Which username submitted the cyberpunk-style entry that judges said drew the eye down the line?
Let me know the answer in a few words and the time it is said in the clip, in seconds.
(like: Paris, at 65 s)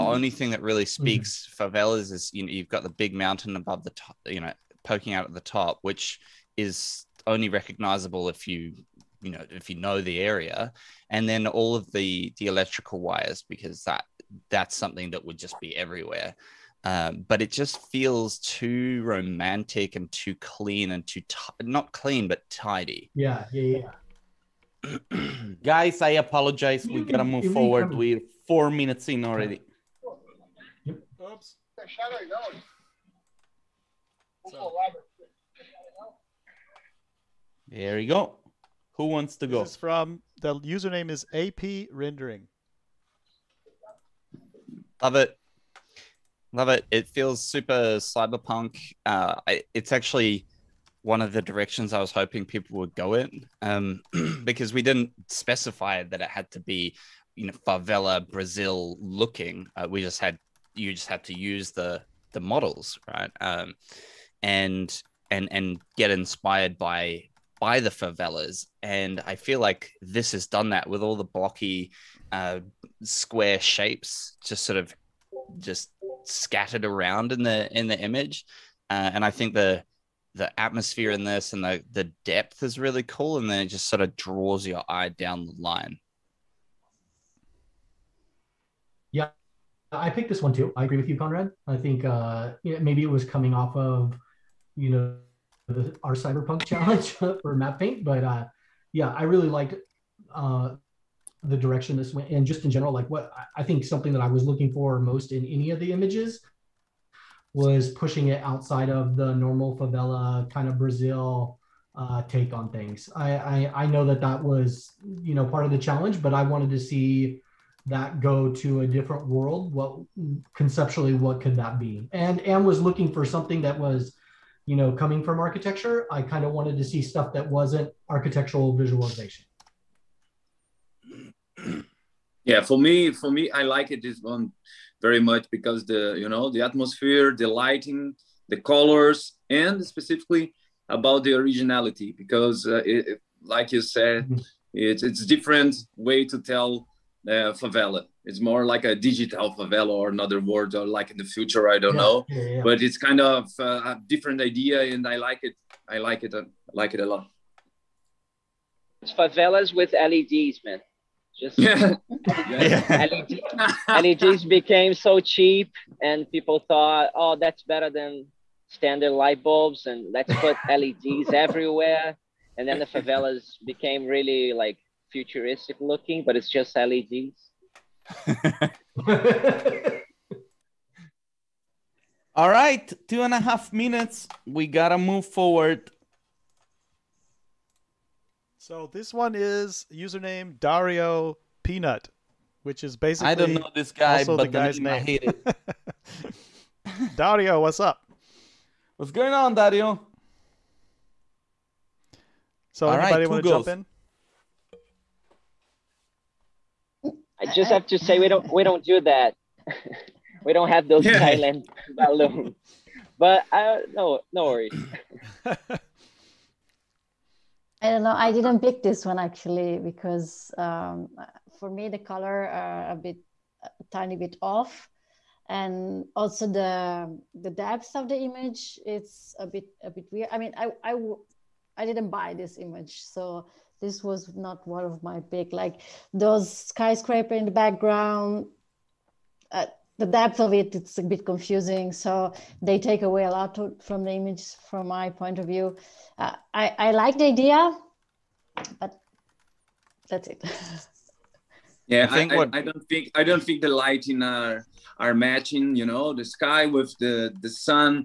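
AP rendering, at 41 s.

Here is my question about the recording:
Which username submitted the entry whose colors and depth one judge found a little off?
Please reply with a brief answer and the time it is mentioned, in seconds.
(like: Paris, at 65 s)
Dario Peanut, at 190 s.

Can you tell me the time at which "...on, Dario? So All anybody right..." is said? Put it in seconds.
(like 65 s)
199 s.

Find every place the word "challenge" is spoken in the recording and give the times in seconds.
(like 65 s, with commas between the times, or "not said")
96 s, 115 s.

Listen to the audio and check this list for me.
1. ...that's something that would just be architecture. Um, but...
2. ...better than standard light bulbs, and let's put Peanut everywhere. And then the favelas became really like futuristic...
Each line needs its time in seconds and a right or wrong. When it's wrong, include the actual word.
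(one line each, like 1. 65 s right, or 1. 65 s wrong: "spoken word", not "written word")
1. 14 s wrong: "everywhere", not "architecture"
2. 167 s wrong: "LEDs", not "Peanut".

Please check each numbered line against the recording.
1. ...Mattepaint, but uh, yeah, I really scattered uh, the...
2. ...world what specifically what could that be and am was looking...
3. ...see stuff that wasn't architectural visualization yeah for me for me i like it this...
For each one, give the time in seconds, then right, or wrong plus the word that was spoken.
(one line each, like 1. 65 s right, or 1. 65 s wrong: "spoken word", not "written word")
1. 97 s wrong: "liked", not "scattered"
2. 119 s wrong: "conceptually", not "specifically"
3. 126 s right.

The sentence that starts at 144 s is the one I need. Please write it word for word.
it's it's different way to tell uh, favela.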